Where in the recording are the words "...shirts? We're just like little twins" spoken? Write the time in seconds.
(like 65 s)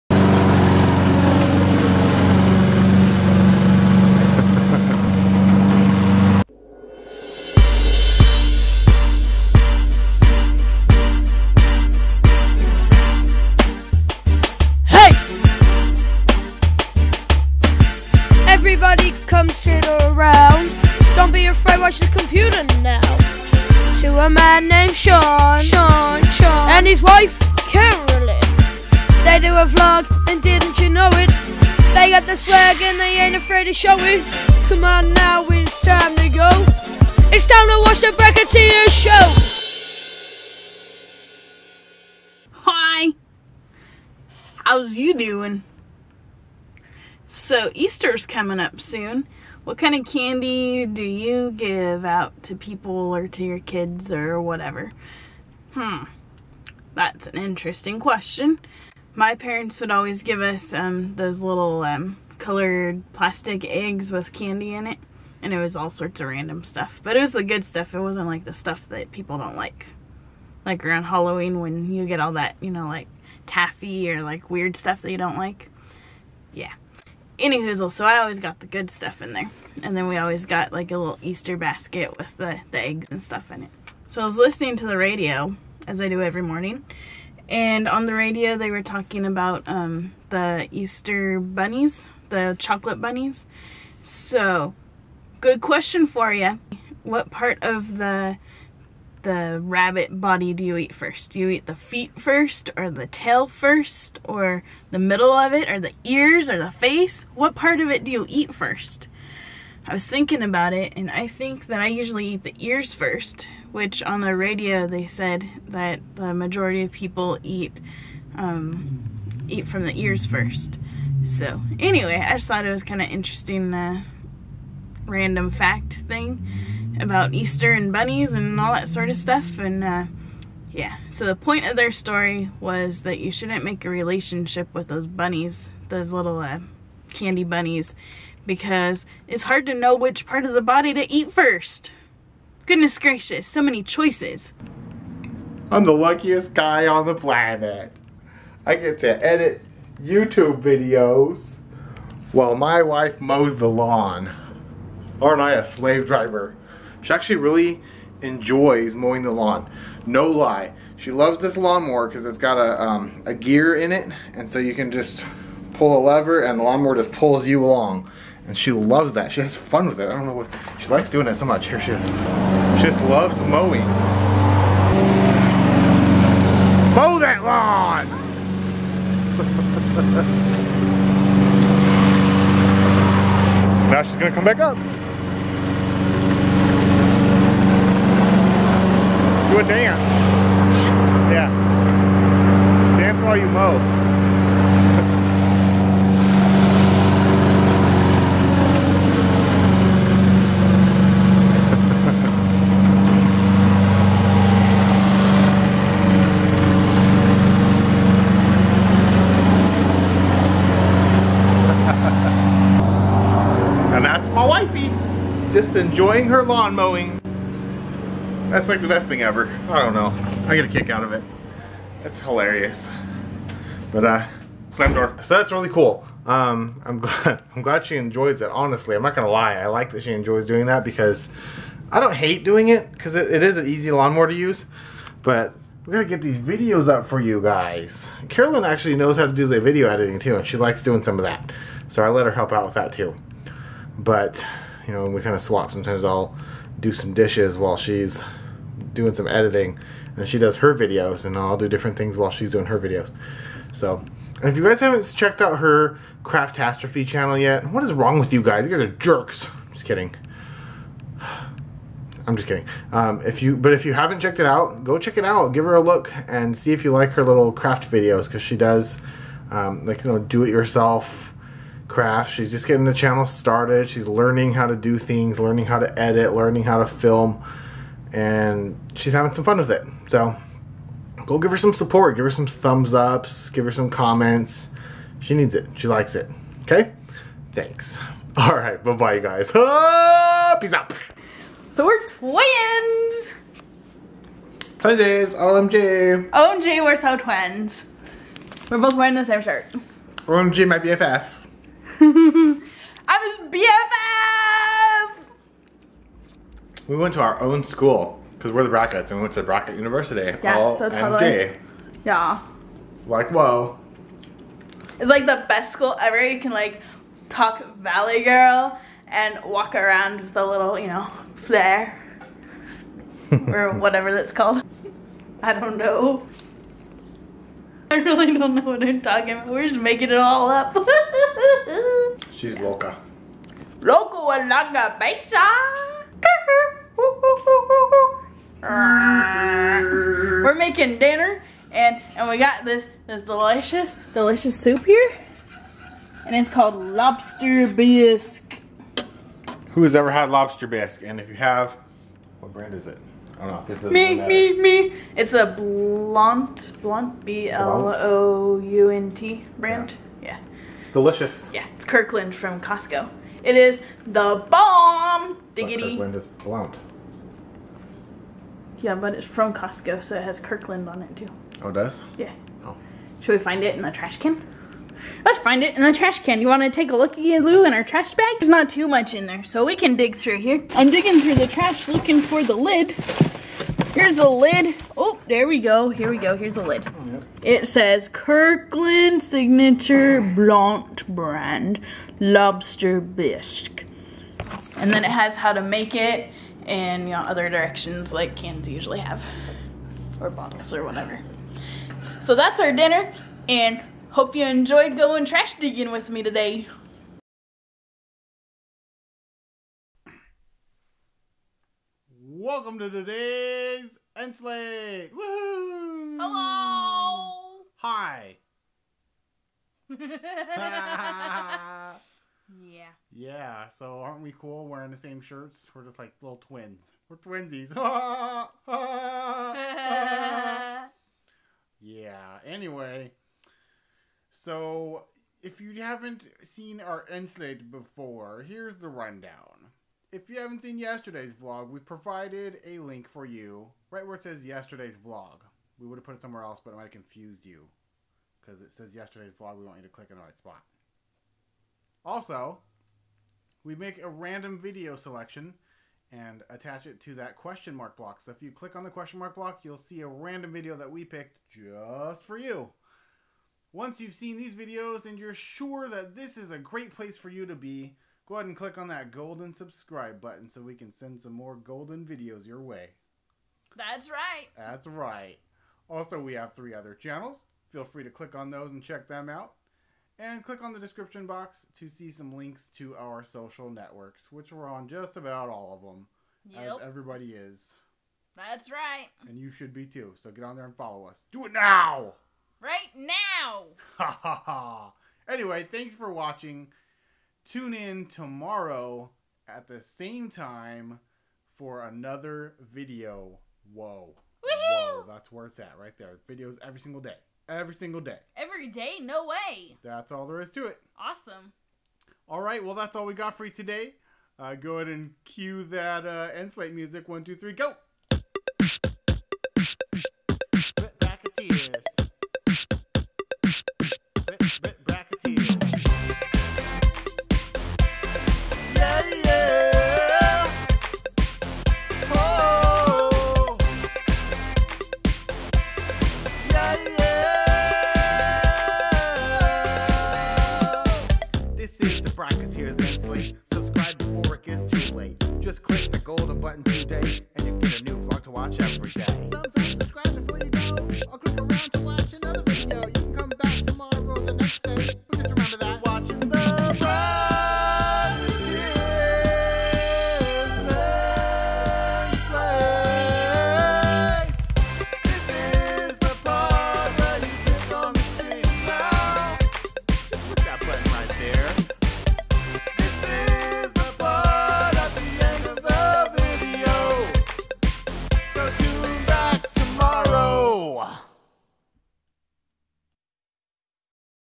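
425 s.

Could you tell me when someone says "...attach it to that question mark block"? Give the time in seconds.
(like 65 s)
456 s.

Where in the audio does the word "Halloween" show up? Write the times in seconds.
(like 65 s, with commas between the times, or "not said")
71 s.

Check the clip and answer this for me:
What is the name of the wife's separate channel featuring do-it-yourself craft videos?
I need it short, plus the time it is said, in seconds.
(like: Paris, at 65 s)
Craftastrophe, at 256 s.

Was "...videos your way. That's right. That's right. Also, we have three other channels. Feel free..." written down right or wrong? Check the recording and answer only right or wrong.
right.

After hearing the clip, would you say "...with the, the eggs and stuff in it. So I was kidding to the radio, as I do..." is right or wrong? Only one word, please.
wrong.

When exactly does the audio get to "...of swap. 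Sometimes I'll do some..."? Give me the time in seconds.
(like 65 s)
245 s.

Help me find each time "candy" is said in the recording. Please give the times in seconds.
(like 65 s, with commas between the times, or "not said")
50 s, 64 s, 137 s.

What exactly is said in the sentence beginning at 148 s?
I get to edit YouTube videos while my wife mows the lawn.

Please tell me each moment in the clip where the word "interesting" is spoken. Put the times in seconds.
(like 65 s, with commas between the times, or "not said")
57 s, 123 s.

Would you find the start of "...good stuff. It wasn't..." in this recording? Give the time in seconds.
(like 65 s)
67 s.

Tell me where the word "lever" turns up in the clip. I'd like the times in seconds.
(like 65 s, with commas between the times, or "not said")
166 s.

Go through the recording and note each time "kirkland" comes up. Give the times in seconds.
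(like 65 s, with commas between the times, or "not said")
361 s, 365 s, 370 s, 388 s.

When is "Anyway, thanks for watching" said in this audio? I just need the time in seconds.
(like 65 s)
495 s.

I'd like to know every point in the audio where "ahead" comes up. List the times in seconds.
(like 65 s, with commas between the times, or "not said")
468 s, 514 s.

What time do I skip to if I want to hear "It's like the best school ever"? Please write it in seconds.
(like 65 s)
314 s.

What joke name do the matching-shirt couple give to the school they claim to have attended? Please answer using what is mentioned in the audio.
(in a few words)
Brackett University.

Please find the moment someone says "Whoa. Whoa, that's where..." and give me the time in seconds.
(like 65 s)
503 s.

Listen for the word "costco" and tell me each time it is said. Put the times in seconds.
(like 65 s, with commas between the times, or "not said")
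362 s, 369 s.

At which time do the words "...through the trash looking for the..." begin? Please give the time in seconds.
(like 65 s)
381 s.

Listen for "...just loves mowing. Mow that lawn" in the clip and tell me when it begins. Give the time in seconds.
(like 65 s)
172 s.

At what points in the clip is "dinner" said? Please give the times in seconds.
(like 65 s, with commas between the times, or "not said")
340 s, 402 s.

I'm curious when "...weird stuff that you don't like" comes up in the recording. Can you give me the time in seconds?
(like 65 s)
74 s.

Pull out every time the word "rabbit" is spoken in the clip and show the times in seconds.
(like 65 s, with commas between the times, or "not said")
99 s.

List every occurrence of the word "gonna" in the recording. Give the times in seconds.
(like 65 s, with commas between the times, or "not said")
184 s, 229 s.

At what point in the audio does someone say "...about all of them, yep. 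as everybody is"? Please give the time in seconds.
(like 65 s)
485 s.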